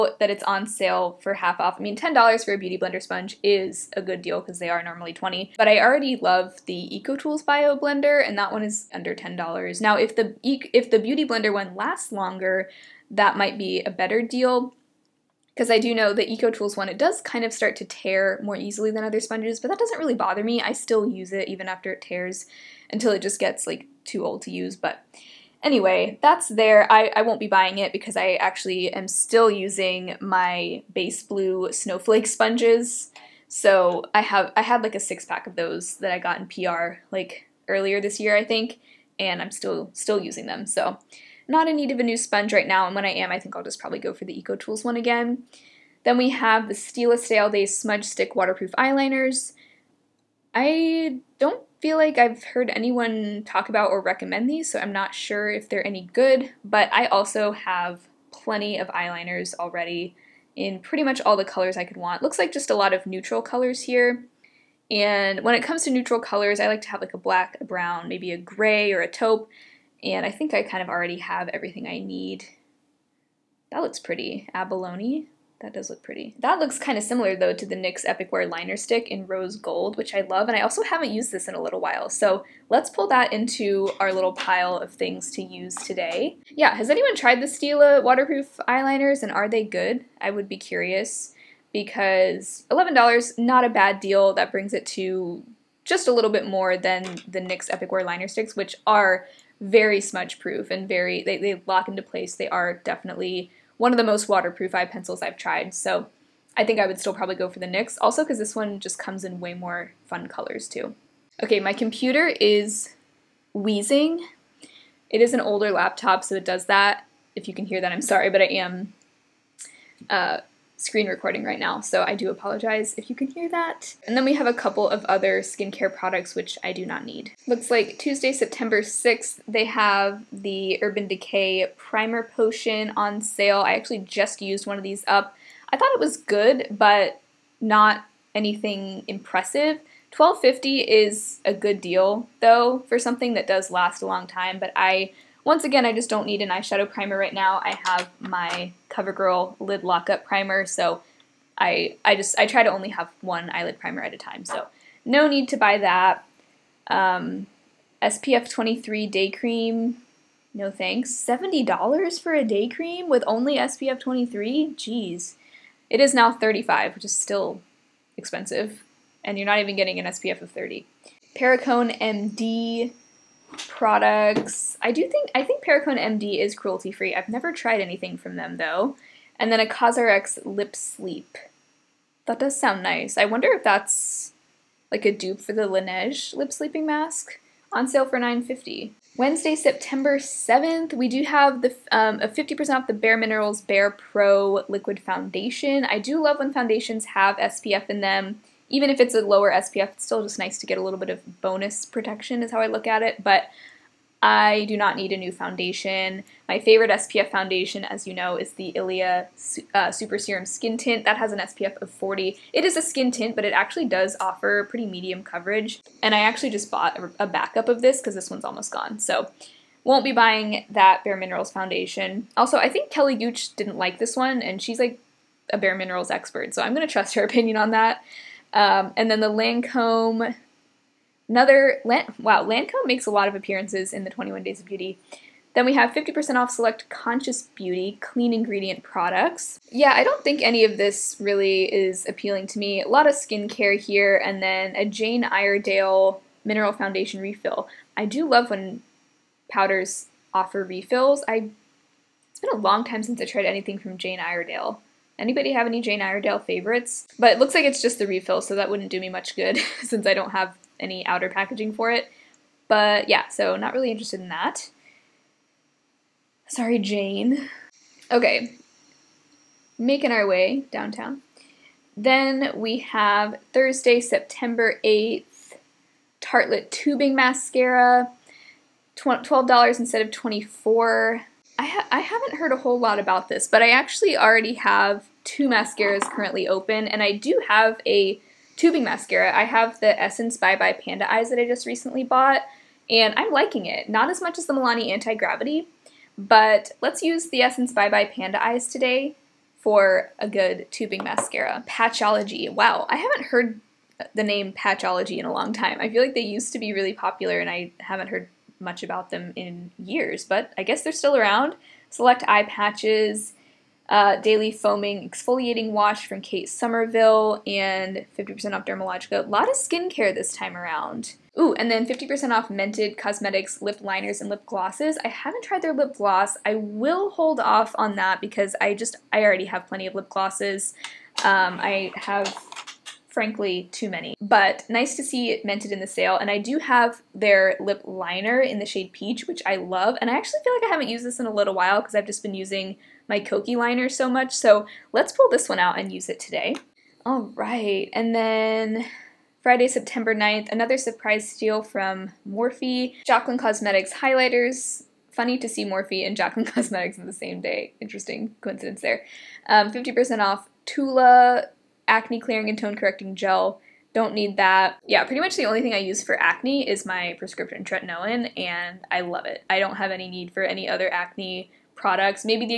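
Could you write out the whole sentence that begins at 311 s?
Select eye patches, uh, daily foaming exfoliating wash from Kate Somerville, and 50% off Dermalogica.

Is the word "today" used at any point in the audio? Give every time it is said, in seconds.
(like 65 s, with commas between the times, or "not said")
85 s, 298 s, 346 s.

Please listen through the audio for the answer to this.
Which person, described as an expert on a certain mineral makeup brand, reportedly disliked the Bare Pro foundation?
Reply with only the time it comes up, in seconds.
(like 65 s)
222 s.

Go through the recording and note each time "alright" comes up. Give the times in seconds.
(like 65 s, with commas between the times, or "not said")
not said.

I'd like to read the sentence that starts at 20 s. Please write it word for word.
I still use it even after it tears until it just gets like too old to use, but Anyway, that's there.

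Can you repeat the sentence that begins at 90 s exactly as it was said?
I would be curious because $11, not a bad deal.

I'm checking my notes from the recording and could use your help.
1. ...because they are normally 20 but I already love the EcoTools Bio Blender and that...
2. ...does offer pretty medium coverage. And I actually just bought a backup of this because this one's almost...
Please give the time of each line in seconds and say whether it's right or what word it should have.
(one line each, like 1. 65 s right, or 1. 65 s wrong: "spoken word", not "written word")
1. 4 s right
2. 213 s right.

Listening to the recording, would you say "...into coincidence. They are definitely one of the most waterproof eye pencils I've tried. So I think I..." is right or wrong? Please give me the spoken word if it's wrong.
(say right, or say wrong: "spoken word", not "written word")
wrong: "place", not "coincidence".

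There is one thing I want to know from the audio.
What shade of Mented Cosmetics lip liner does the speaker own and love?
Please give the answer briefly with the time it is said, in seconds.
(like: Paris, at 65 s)
Peach, at 338 s.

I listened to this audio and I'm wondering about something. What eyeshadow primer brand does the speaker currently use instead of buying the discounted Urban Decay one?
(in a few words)
CoverGirl.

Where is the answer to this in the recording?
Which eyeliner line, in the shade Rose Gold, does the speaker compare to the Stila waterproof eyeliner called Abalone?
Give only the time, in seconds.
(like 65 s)
77 s.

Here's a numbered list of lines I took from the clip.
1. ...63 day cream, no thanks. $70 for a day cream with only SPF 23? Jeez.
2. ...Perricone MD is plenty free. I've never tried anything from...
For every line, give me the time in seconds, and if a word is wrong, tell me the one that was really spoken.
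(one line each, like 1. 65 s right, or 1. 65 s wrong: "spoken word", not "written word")
1. 158 s wrong: "23", not "63"
2. 175 s wrong: "cruelty", not "plenty".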